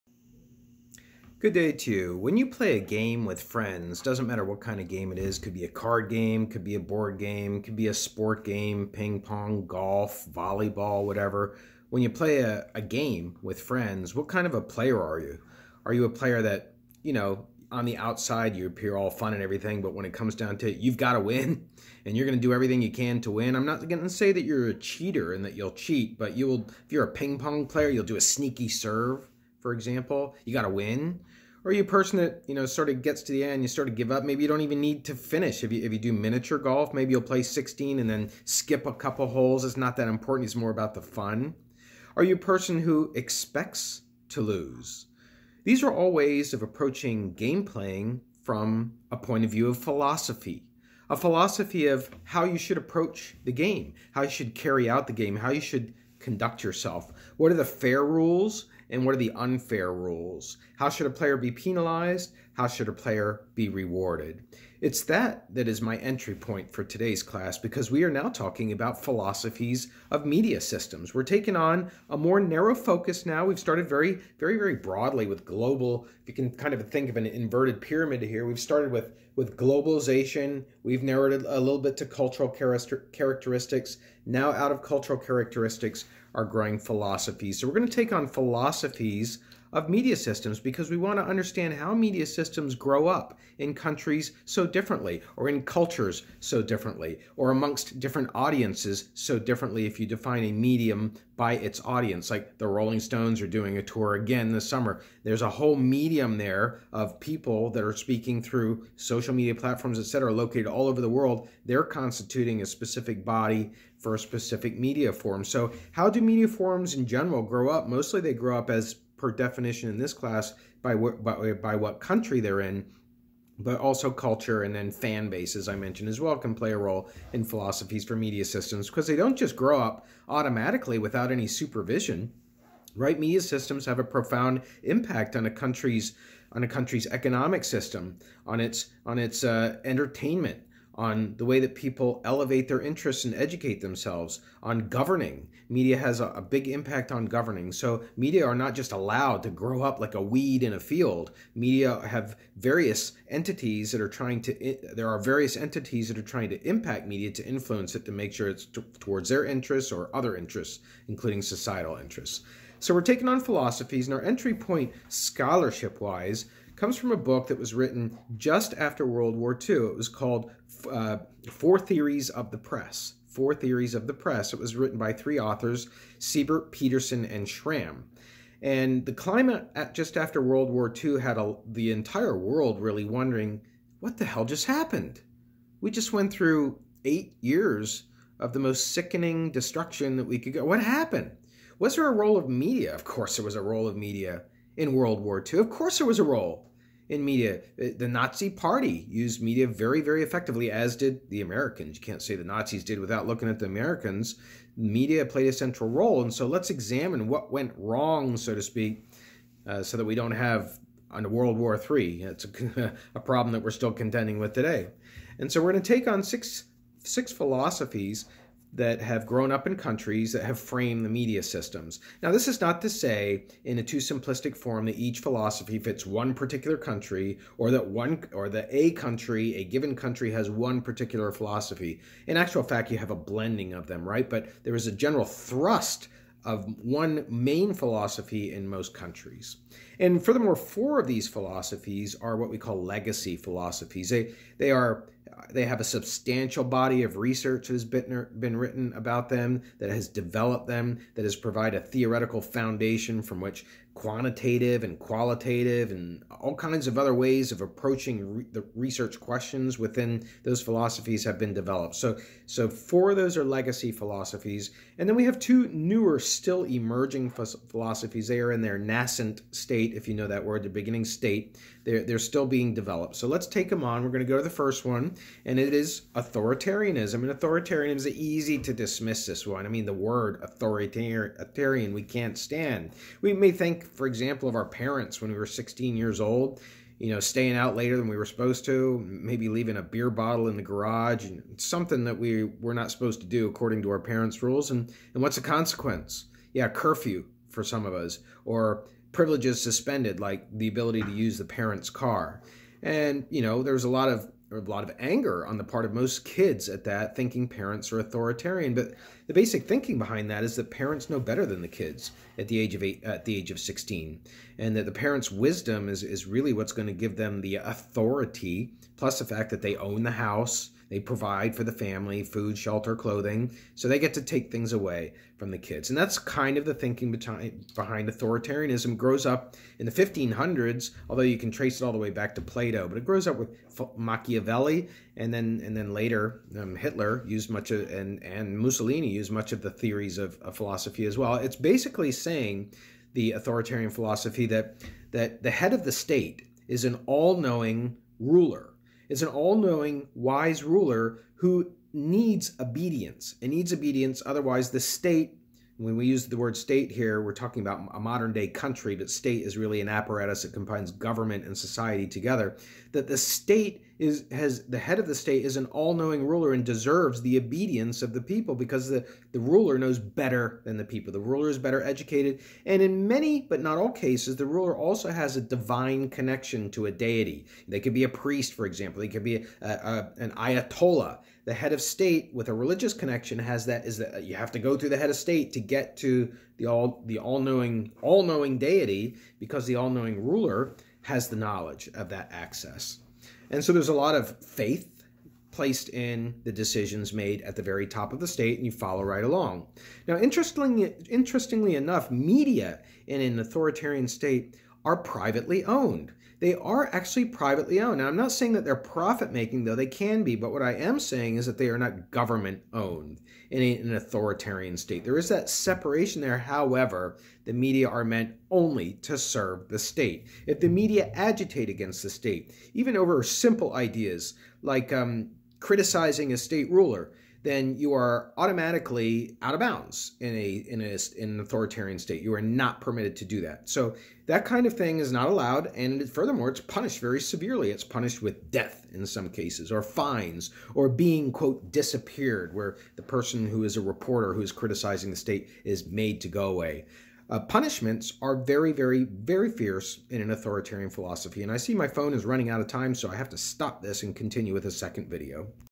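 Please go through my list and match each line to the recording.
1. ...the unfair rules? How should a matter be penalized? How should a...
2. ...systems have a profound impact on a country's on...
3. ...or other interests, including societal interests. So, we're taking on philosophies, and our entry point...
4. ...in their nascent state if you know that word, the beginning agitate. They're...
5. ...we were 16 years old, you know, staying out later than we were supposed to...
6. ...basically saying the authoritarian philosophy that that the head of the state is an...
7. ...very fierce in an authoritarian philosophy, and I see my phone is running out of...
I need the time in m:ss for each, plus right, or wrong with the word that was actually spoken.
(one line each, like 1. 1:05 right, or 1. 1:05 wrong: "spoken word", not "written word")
1. 0:59 wrong: "player", not "matter"
2. 2:13 right
3. 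2:39 right
4. 4:28 wrong: "state", not "agitate"
5. 4:45 right
6. 5:41 right
7. 7:29 right.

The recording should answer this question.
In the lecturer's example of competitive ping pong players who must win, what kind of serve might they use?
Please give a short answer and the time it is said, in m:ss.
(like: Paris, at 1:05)
sneaky serve, at 0:28.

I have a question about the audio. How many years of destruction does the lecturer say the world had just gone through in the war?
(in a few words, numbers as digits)
eight years.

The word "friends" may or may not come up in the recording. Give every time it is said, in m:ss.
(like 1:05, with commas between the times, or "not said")
0:03, 0:13.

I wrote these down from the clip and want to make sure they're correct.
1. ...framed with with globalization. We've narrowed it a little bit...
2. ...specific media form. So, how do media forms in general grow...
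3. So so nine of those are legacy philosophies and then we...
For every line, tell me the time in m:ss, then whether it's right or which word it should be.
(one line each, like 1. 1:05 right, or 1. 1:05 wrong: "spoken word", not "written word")
1. 1:18 wrong: "started", not "framed"
2. 1:54 right
3. 4:21 wrong: "four", not "nine".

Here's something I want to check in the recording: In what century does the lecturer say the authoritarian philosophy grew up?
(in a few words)
1500s.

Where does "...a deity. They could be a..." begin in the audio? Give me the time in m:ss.
6:16.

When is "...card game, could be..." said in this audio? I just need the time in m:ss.
0:05.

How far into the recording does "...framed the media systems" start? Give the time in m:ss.
3:40.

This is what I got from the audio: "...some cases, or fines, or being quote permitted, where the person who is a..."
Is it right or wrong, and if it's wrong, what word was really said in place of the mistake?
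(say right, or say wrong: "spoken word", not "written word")
wrong: "disappeared", not "permitted".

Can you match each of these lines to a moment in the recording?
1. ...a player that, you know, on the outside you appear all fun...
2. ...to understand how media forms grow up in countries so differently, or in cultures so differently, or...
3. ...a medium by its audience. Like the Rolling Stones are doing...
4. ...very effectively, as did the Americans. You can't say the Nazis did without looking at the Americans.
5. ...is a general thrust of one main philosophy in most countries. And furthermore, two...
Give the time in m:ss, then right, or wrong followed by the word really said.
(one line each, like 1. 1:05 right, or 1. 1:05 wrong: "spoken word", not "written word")
1. 0:16 right
2. 1:31 wrong: "systems", not "forms"
3. 1:40 right
4. 3:19 right
5. 3:54 wrong: "four", not "two".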